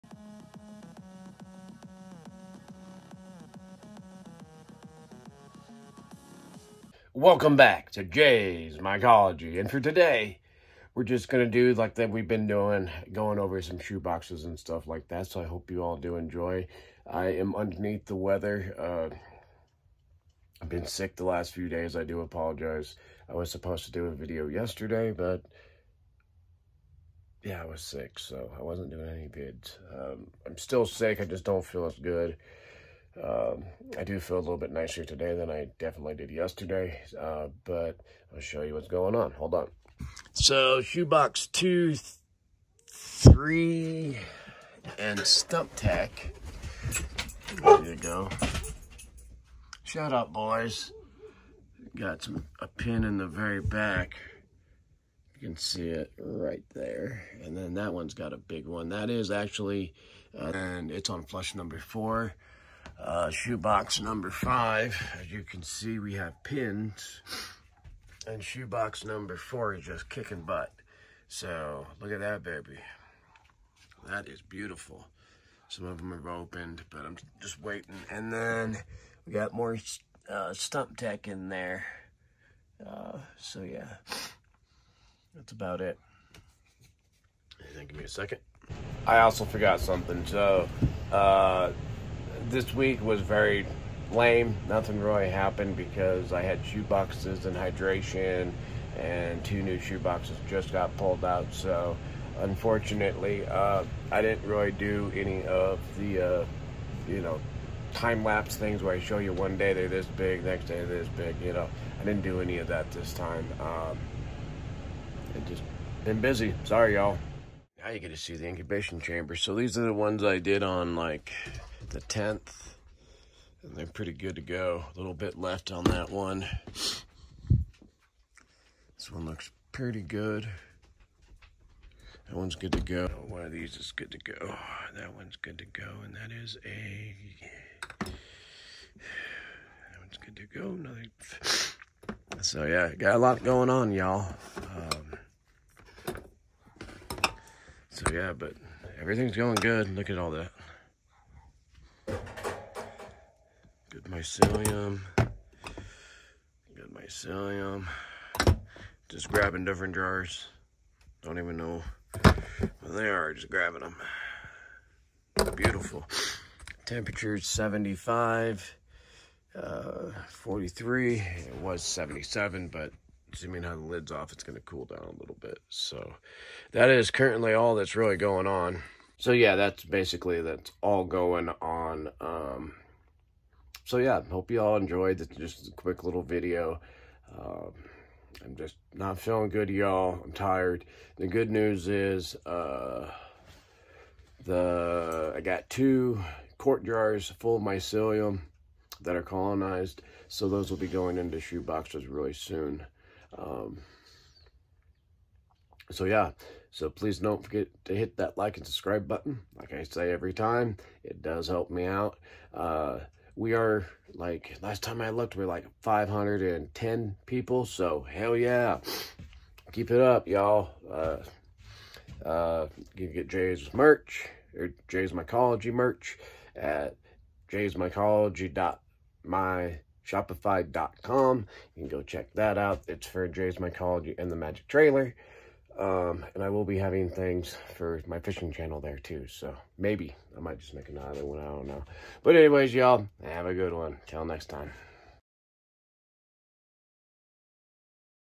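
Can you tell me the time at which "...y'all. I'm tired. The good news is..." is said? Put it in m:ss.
3:09.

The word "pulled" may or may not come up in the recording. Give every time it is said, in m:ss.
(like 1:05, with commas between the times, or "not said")
1:40.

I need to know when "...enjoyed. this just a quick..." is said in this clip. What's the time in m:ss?
3:04.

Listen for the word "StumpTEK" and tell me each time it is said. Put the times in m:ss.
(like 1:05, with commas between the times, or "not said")
0:45, 1:20.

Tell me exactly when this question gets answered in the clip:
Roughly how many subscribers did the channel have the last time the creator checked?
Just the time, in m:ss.
3:35.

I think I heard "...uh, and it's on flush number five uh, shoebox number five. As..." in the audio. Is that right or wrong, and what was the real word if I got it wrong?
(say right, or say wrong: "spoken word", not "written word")
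wrong: "four", not "five".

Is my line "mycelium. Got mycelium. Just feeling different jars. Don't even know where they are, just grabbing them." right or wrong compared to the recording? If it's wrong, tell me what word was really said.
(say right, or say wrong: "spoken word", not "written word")
wrong: "grabbing", not "feeling".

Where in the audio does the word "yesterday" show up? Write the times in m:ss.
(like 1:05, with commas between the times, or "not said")
0:24, 0:36.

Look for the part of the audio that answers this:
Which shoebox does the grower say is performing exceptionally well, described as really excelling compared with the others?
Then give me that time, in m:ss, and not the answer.
1:08.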